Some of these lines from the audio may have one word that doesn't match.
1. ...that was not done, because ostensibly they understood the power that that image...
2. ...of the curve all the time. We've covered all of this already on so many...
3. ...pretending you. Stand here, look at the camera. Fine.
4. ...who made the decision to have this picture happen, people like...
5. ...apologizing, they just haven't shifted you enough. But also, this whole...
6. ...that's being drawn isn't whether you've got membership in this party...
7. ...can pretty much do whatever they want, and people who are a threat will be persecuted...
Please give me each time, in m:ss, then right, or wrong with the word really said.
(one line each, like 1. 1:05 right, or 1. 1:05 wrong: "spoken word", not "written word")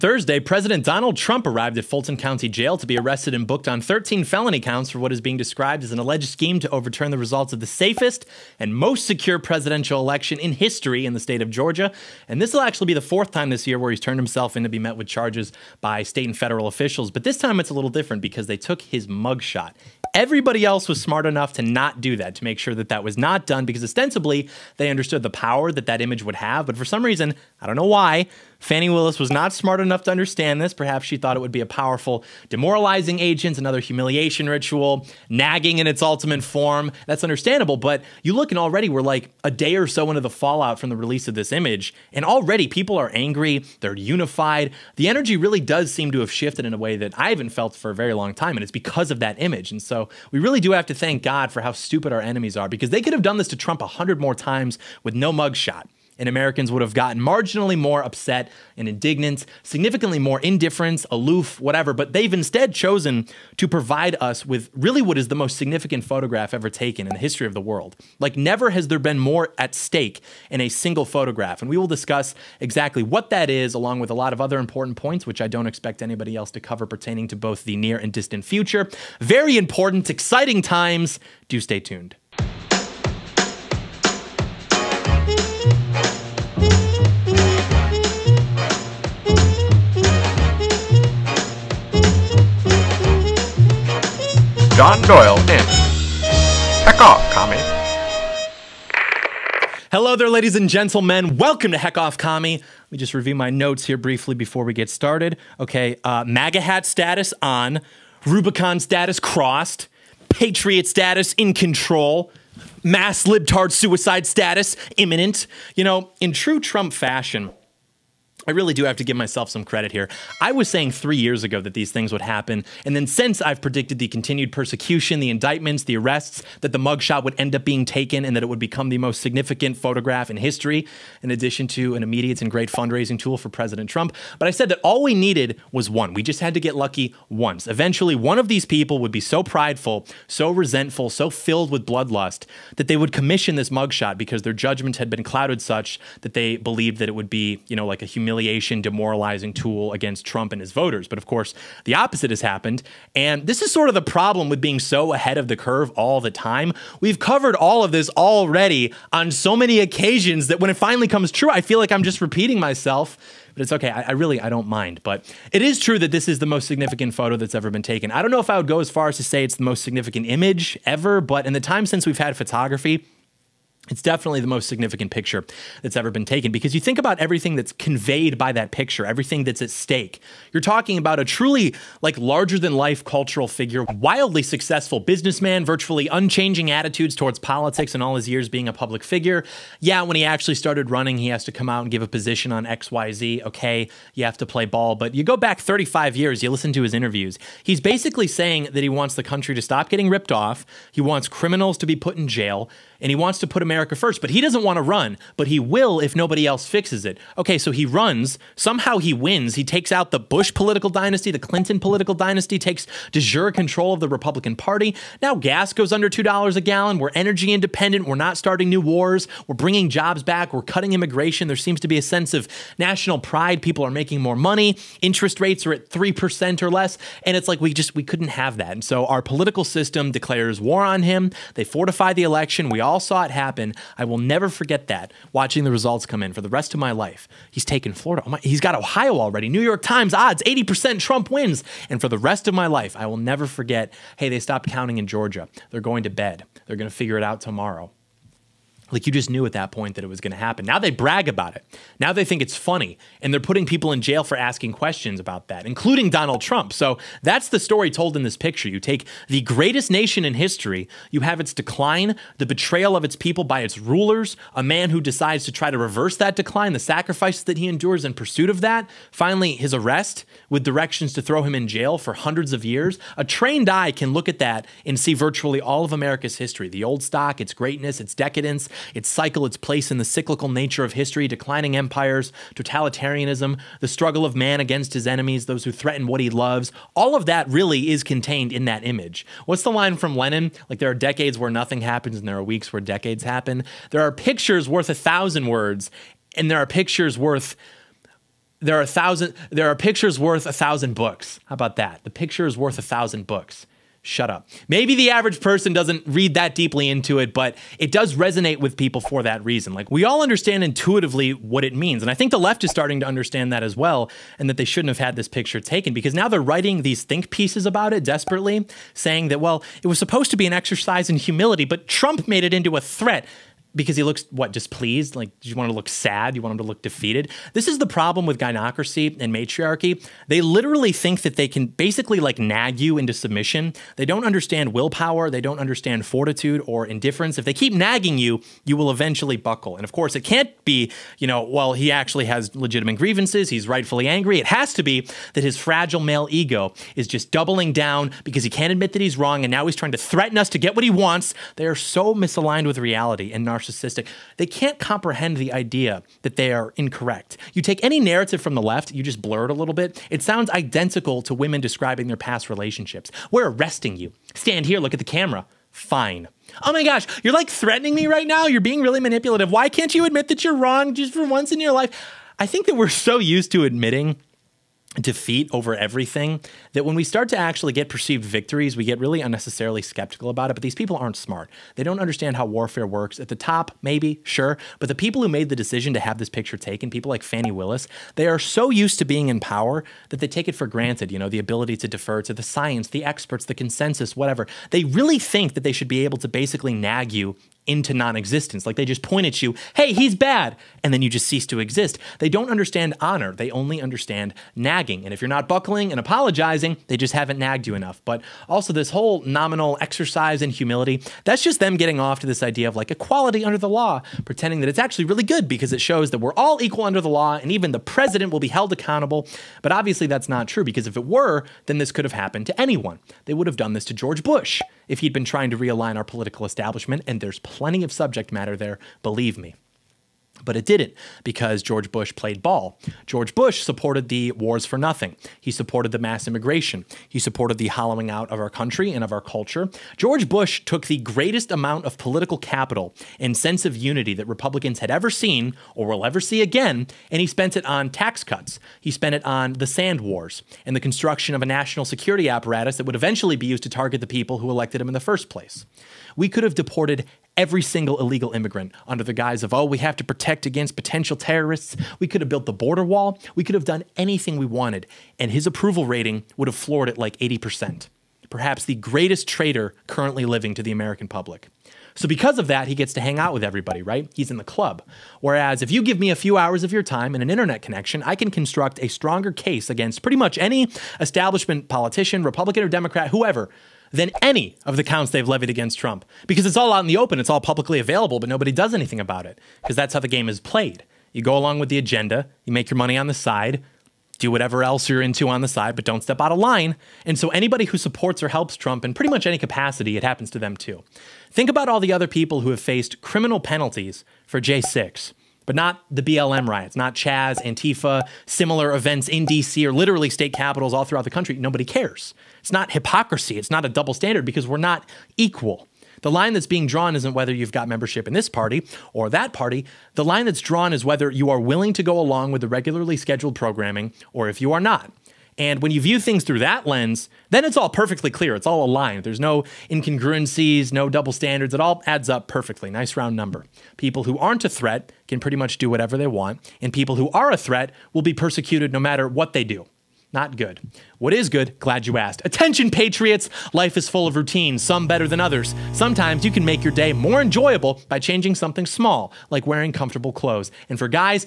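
1. 0:22 right
2. 2:35 right
3. 6:03 wrong: "arresting", not "pretending"
4. 6:25 wrong: "taken", not "happen"
5. 6:45 wrong: "nagged", not "shifted"
6. 8:36 right
7. 8:55 right.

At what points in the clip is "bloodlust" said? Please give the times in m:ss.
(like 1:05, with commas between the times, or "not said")
2:21.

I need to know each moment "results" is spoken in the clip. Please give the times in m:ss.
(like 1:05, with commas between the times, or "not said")
0:07, 3:55.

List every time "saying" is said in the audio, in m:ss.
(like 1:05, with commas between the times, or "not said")
2:00, 3:18, 5:18.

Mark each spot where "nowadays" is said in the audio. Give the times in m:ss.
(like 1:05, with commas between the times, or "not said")
not said.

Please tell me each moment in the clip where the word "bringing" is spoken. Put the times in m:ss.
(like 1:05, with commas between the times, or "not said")
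3:39.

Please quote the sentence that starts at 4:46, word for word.
All of that really is contained in that image.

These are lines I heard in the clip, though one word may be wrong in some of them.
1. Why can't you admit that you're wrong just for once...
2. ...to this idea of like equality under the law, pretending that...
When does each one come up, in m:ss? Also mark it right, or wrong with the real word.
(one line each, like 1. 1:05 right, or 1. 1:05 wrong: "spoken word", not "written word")
1. 6:09 right
2. 6:52 right.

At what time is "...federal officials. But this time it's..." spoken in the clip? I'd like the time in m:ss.
0:16.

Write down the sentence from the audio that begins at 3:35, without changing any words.
Now gas goes under $2 a gallon.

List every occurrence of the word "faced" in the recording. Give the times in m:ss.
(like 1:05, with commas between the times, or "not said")
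8:22.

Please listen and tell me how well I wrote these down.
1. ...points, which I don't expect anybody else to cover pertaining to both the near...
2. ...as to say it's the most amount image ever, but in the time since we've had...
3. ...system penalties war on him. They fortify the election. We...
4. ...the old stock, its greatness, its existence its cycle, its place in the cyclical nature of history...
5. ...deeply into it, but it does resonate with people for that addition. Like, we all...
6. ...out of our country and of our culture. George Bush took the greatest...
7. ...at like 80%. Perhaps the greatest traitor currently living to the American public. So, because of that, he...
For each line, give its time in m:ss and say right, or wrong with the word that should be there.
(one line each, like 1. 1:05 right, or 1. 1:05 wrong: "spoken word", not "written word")
1. 1:14 right
2. 2:49 wrong: "significant", not "amount"
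3. 3:49 wrong: "declares", not "penalties"
4. 4:36 wrong: "decadence", not "existence"
5. 5:06 wrong: "reason", not "addition"
6. 7:18 right
7. 7:46 right.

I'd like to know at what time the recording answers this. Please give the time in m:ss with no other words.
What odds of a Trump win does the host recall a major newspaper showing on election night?
4:00.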